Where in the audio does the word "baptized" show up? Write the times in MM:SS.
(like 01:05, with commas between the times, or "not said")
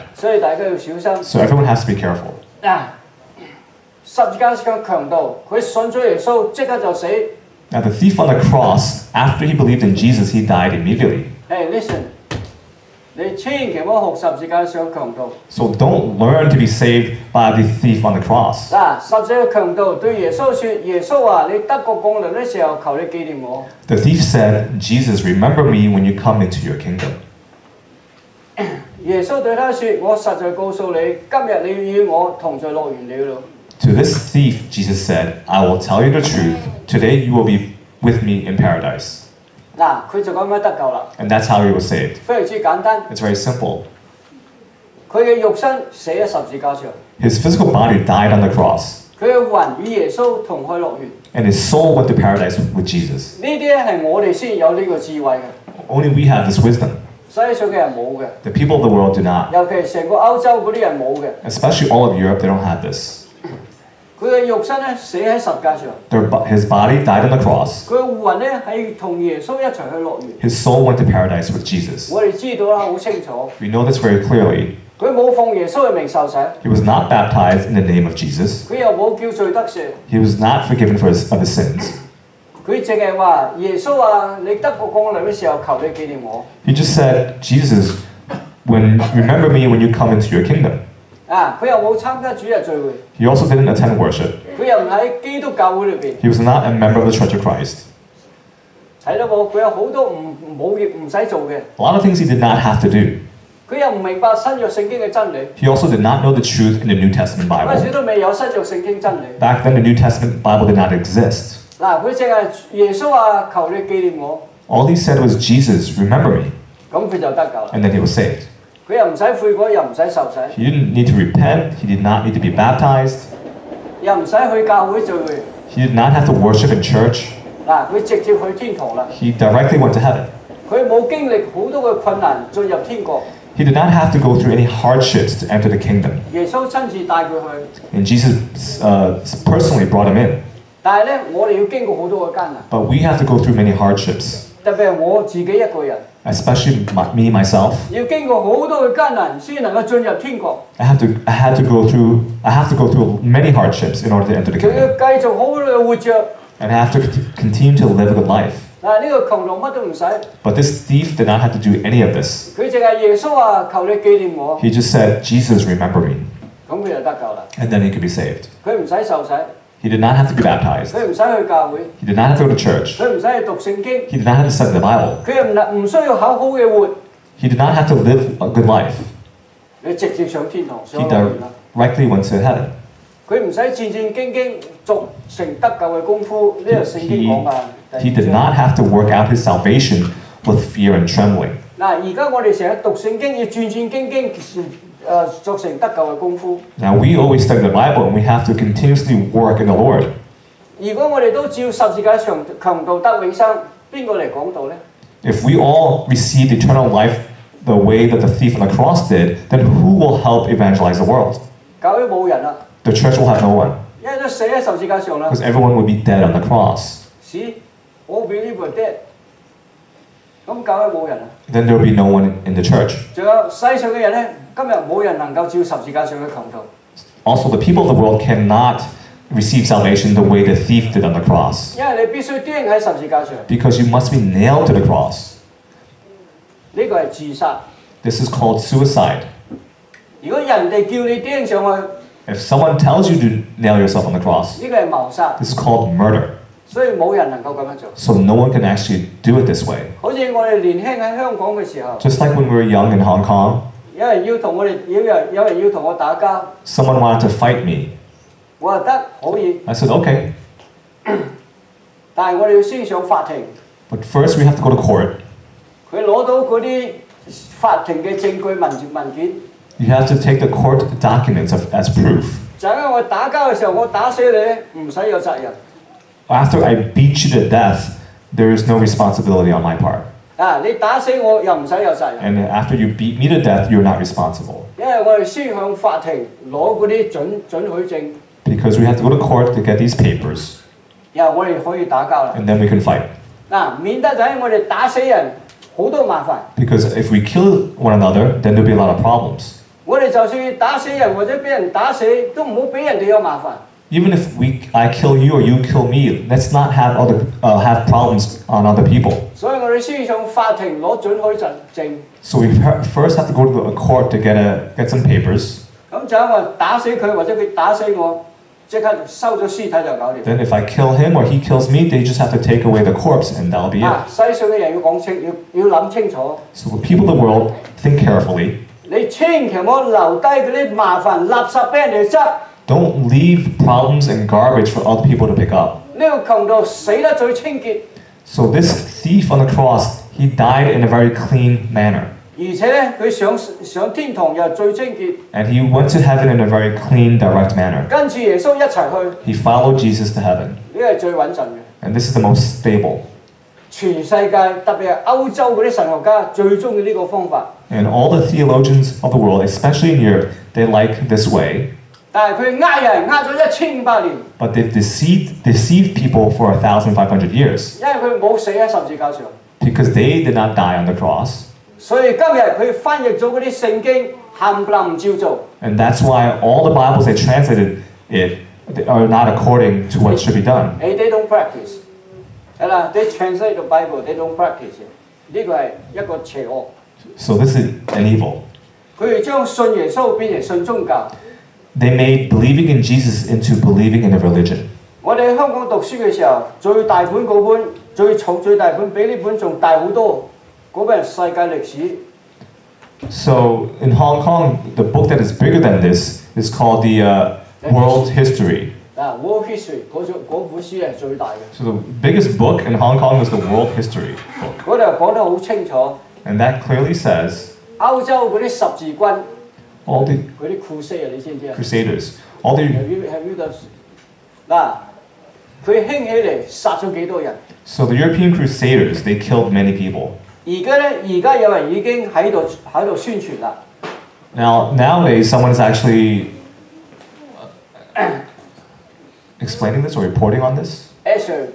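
01:17, 02:02, 02:50.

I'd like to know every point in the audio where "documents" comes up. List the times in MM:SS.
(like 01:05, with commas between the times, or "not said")
04:31.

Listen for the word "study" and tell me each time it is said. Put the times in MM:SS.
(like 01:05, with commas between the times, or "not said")
02:54, 03:17.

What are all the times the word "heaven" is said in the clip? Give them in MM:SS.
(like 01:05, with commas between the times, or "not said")
02:09, 03:02, 05:46, 05:50.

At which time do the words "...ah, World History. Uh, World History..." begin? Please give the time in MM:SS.
06:47.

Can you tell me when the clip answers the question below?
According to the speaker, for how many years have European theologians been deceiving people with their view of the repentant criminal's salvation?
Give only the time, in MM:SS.
06:06.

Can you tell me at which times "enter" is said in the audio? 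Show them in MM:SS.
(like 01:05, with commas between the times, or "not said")
02:15, 02:34.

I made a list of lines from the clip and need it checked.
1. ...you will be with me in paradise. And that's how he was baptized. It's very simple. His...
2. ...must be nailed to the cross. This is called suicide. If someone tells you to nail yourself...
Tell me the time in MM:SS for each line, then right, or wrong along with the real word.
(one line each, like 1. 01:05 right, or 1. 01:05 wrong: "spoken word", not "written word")
1. 00:37 wrong: "saved", not "baptized"
2. 03:53 right.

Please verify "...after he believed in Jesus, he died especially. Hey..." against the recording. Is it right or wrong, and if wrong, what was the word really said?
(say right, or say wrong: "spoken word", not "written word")
wrong: "immediately", not "especially".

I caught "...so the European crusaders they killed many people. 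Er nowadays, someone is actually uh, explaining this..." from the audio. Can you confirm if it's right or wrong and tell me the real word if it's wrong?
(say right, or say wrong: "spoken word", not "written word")
right.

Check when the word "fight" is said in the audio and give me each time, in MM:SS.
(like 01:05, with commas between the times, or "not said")
04:17.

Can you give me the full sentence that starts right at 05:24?
So the people of the world, think carefully.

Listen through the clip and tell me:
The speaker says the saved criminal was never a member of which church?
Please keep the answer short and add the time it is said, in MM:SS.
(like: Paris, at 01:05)
Church of Christ, at 01:37.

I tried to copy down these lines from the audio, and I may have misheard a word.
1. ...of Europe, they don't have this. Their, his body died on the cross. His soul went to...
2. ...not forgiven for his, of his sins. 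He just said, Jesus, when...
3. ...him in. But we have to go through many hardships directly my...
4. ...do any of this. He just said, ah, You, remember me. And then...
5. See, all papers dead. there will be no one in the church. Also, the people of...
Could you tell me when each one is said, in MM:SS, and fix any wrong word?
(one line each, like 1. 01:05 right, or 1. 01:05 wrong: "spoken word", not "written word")
1. 01:02 right
2. 01:20 right
3. 02:20 wrong: "especially", not "directly"
4. 02:41 wrong: "Jesus", not "You"
5. 03:37 wrong: "believers", not "papers".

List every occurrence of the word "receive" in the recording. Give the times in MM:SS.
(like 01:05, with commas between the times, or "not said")
03:26, 03:49.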